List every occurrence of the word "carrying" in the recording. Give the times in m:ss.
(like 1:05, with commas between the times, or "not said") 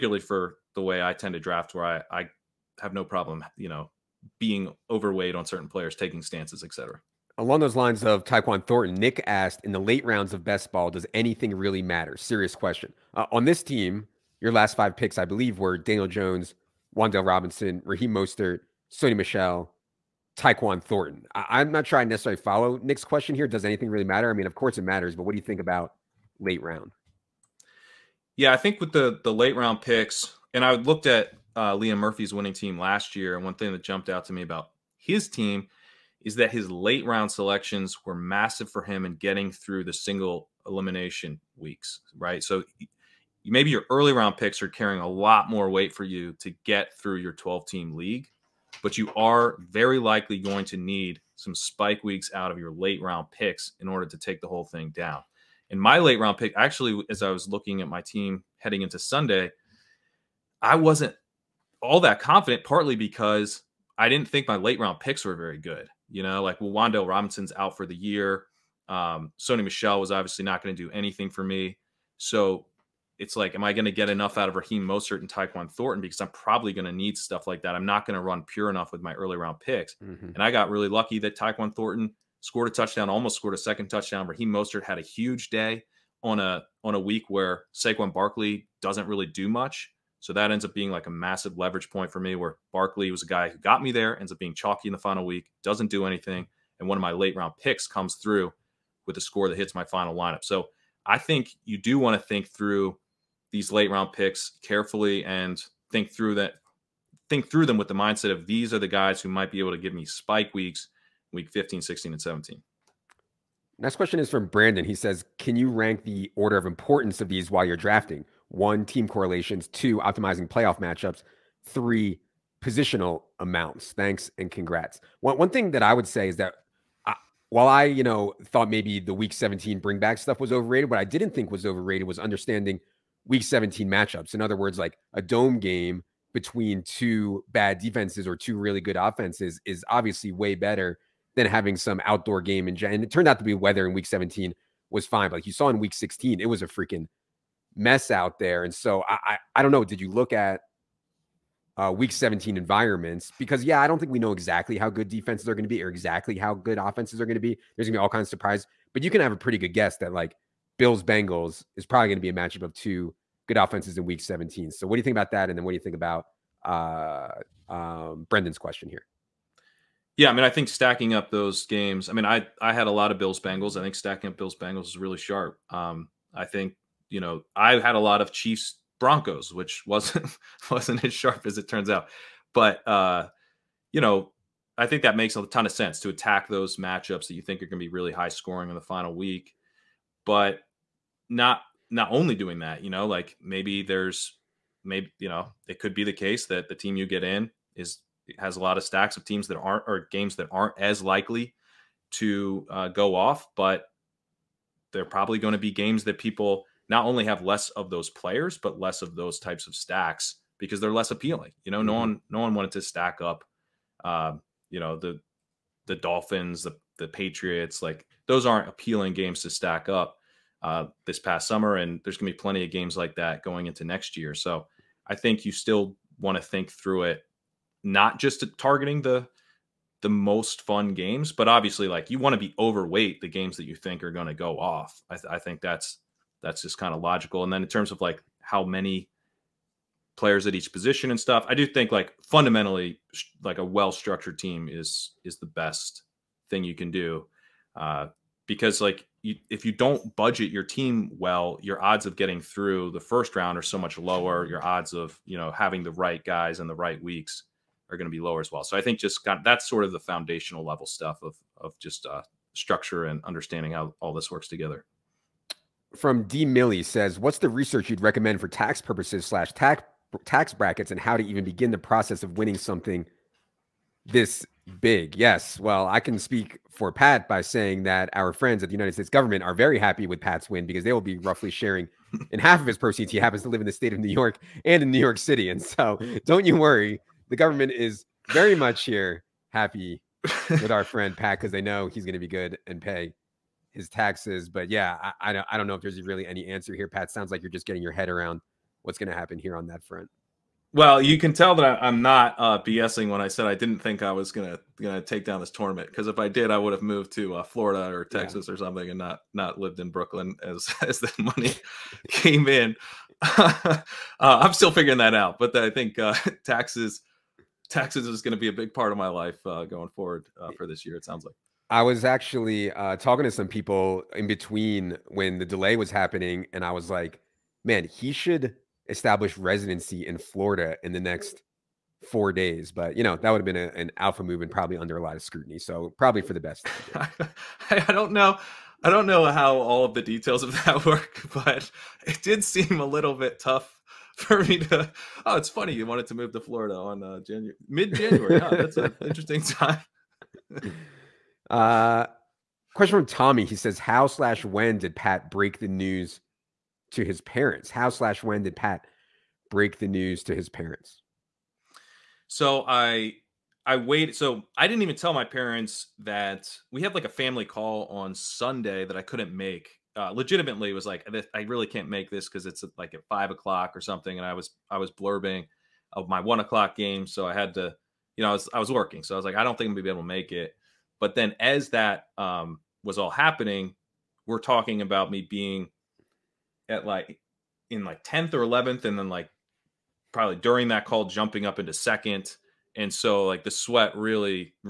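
0:44.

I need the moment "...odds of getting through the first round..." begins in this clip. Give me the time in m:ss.
4:11.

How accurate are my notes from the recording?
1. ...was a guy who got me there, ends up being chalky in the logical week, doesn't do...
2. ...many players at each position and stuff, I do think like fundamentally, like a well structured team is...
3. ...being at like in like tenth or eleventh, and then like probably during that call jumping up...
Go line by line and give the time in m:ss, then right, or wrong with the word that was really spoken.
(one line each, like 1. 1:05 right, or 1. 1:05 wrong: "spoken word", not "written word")
1. 1:33 wrong: "final", not "logical"
2. 3:58 right
3. 6:25 right.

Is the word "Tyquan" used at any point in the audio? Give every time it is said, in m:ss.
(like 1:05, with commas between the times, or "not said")
0:08, 0:20, 1:15, 1:21.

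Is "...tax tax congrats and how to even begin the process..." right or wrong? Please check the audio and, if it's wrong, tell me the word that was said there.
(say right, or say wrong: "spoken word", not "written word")
wrong: "brackets", not "congrats".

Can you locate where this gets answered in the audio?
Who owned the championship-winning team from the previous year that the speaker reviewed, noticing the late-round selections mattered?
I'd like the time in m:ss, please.
0:31.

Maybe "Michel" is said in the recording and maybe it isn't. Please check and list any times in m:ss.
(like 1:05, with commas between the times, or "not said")
0:19, 1:09.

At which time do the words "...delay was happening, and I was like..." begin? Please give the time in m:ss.
5:25.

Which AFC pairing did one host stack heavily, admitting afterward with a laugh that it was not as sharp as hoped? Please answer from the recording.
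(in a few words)
Chiefs Broncos.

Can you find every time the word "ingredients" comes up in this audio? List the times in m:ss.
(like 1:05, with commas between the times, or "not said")
not said.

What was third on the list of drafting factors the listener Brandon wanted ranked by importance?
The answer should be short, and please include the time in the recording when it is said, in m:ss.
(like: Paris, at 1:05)
positional amounts, at 2:02.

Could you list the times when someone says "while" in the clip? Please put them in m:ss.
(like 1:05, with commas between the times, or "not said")
1:57, 2:07.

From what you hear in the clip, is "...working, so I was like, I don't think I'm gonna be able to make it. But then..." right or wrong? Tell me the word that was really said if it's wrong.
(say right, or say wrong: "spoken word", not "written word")
right.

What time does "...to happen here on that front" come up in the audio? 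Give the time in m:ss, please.
4:59.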